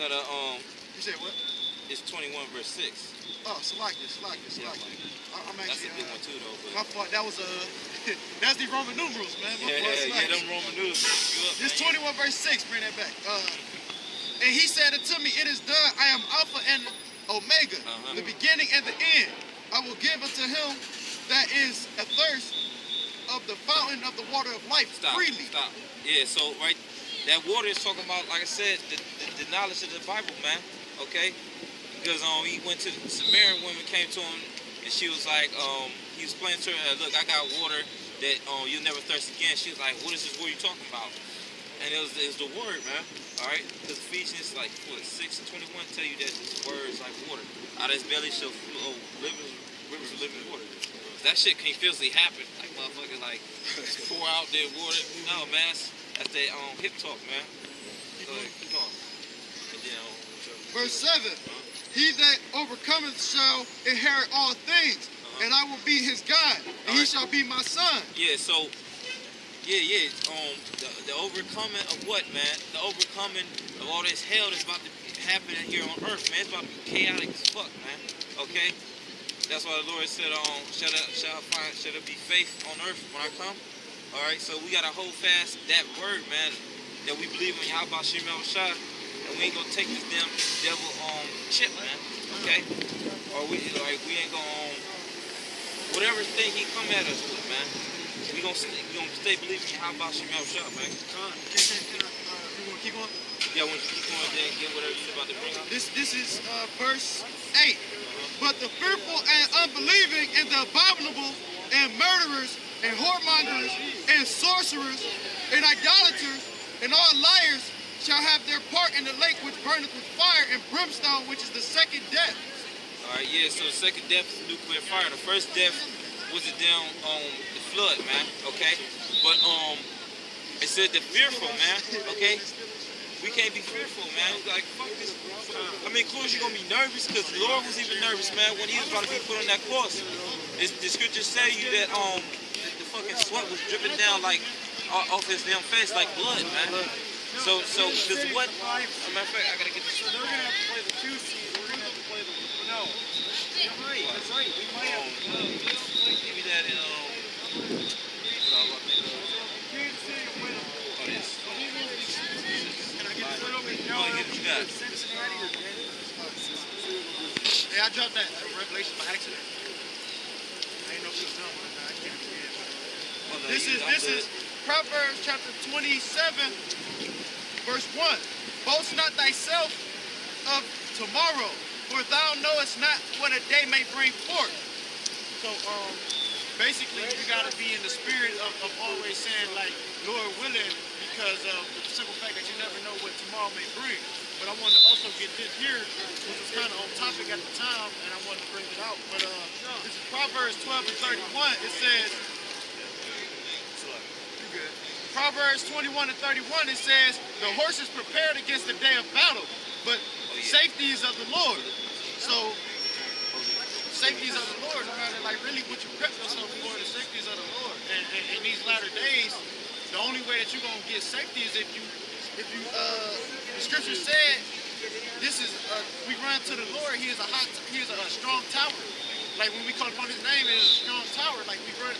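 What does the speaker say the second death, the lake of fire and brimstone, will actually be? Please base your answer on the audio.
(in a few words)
nuclear fire.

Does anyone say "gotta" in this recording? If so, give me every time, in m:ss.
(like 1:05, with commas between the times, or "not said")
2:29.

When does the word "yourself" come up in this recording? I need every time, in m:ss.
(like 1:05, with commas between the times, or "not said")
3:36.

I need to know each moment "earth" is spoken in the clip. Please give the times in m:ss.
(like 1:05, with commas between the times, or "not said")
1:16, 1:22.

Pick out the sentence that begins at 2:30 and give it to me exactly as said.
So they're gonna have to play the two seed.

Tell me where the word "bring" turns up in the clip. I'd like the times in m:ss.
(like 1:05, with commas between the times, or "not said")
0:12, 1:45, 3:03, 3:13, 3:18.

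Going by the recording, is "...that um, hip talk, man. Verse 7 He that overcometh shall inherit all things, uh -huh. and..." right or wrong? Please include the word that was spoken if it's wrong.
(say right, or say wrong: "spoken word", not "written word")
right.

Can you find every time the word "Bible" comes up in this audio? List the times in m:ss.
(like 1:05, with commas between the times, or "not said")
0:30.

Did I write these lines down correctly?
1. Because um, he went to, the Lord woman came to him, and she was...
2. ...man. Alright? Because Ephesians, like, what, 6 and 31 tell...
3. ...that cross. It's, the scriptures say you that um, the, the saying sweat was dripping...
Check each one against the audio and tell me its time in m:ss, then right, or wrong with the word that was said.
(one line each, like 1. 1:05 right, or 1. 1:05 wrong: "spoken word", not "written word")
1. 0:32 wrong: "Samaritan", not "Lord"
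2. 0:42 wrong: "21", not "31"
3. 2:19 wrong: "fucking", not "saying".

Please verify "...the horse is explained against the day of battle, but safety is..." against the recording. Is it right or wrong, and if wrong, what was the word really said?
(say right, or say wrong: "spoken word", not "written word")
wrong: "prepared", not "explained".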